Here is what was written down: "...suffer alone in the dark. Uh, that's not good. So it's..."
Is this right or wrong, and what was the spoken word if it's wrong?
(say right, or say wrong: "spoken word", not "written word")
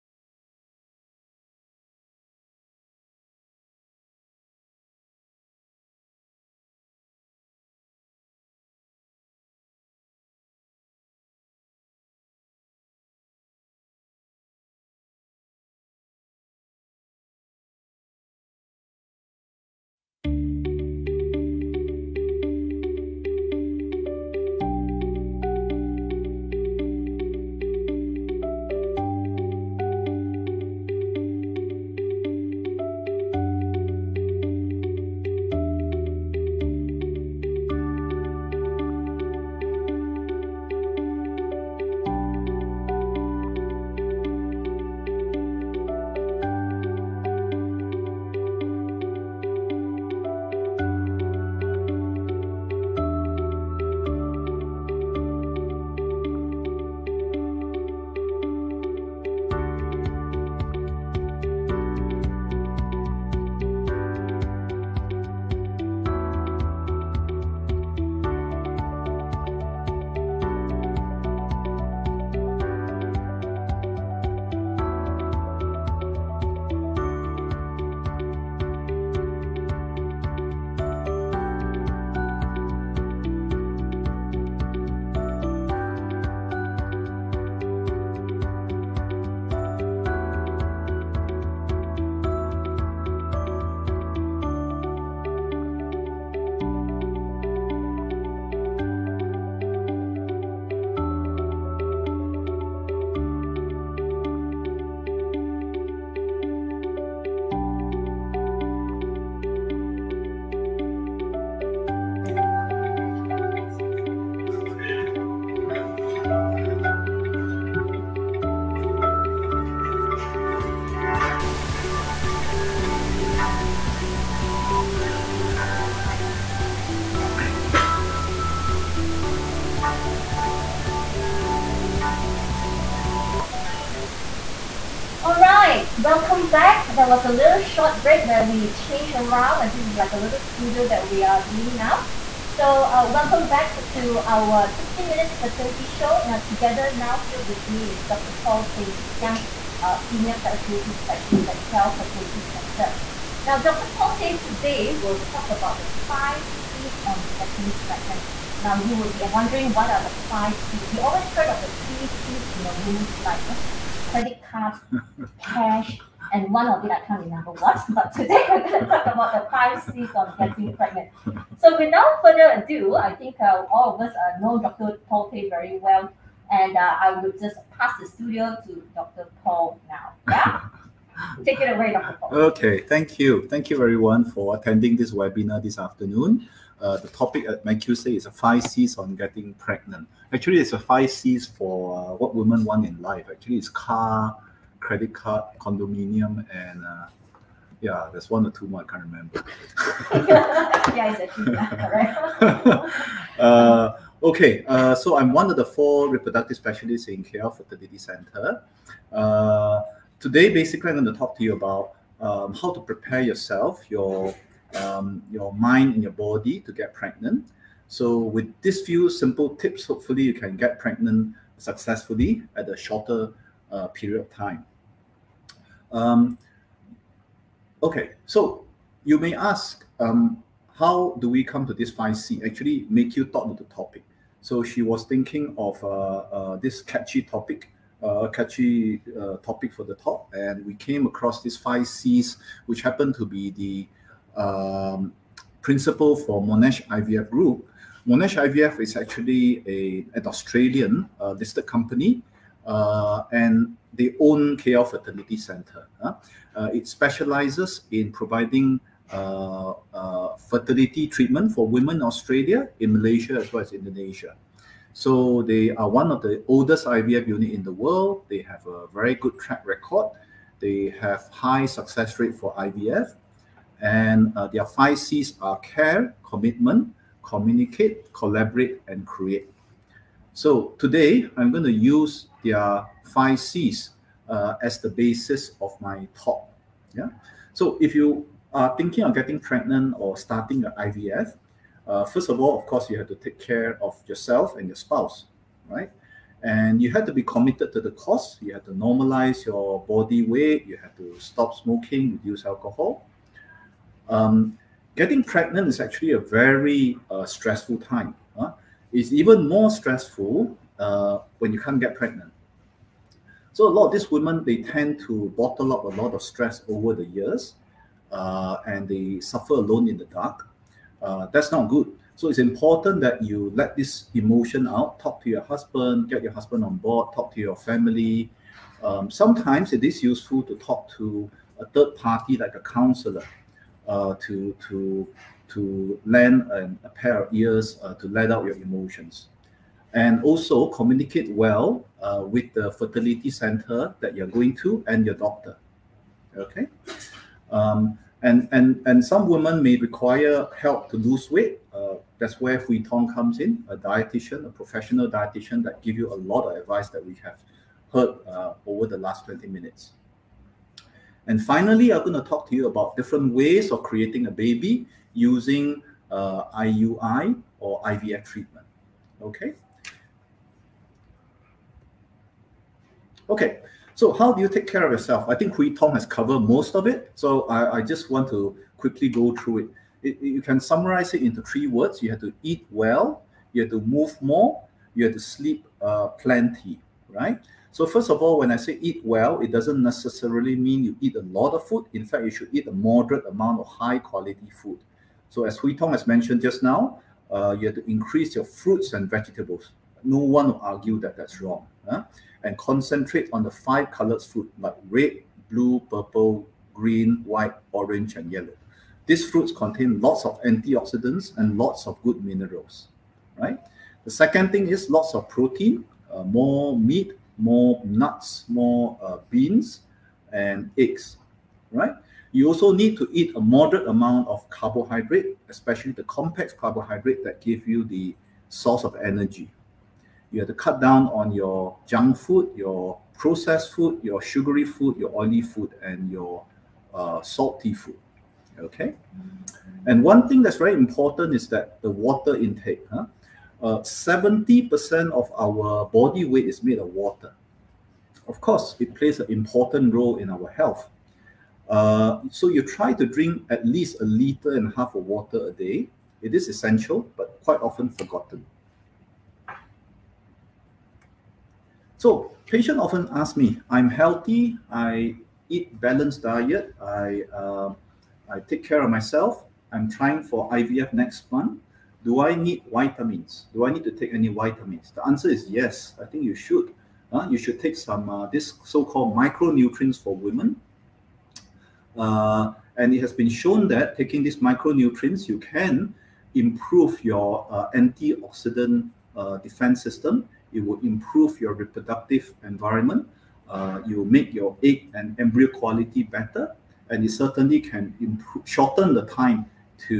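right.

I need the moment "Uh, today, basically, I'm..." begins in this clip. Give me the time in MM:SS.
03:29.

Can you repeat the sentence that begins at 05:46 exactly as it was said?
Okay, um, and and and some women may require help to lose weight.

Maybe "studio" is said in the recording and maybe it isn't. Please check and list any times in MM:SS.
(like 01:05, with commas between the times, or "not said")
02:20, 02:58.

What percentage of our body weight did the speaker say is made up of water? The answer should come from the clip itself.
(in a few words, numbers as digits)
70%.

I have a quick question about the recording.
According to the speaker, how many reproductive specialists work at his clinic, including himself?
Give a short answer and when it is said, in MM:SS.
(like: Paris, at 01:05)
4, at 03:25.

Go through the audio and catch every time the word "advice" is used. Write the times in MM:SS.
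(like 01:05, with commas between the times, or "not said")
05:56.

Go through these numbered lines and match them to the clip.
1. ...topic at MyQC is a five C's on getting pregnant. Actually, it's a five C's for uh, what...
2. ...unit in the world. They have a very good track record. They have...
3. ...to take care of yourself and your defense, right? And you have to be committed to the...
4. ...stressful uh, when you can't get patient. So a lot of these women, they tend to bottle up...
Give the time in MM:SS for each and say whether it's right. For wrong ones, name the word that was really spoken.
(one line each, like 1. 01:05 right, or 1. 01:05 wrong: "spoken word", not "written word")
1. 03:07 right
2. 04:27 right
3. 04:53 wrong: "spouse", not "defense"
4. 05:09 wrong: "pregnant", not "patient".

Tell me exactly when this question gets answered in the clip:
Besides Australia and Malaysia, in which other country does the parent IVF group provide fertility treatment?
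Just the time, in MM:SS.
04:23.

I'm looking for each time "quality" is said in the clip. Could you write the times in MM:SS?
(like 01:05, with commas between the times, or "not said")
06:33, 08:15.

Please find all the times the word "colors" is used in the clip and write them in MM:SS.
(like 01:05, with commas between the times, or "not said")
06:43.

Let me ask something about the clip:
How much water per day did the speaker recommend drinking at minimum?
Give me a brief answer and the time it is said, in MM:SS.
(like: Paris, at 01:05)
1.5 liters, at 07:34.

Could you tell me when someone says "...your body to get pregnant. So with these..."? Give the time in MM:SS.
03:36.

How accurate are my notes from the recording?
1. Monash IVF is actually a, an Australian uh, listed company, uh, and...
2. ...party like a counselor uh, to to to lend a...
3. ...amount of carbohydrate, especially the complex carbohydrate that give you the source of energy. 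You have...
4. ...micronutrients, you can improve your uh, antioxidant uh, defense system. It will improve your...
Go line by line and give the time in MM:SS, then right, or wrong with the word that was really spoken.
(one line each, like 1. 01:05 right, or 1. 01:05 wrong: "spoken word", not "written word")
1. 04:08 right
2. 05:31 right
3. 07:03 right
4. 08:04 right.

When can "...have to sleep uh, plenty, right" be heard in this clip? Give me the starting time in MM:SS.
06:25.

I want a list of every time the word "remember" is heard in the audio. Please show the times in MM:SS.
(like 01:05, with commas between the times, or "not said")
02:47, 03:19.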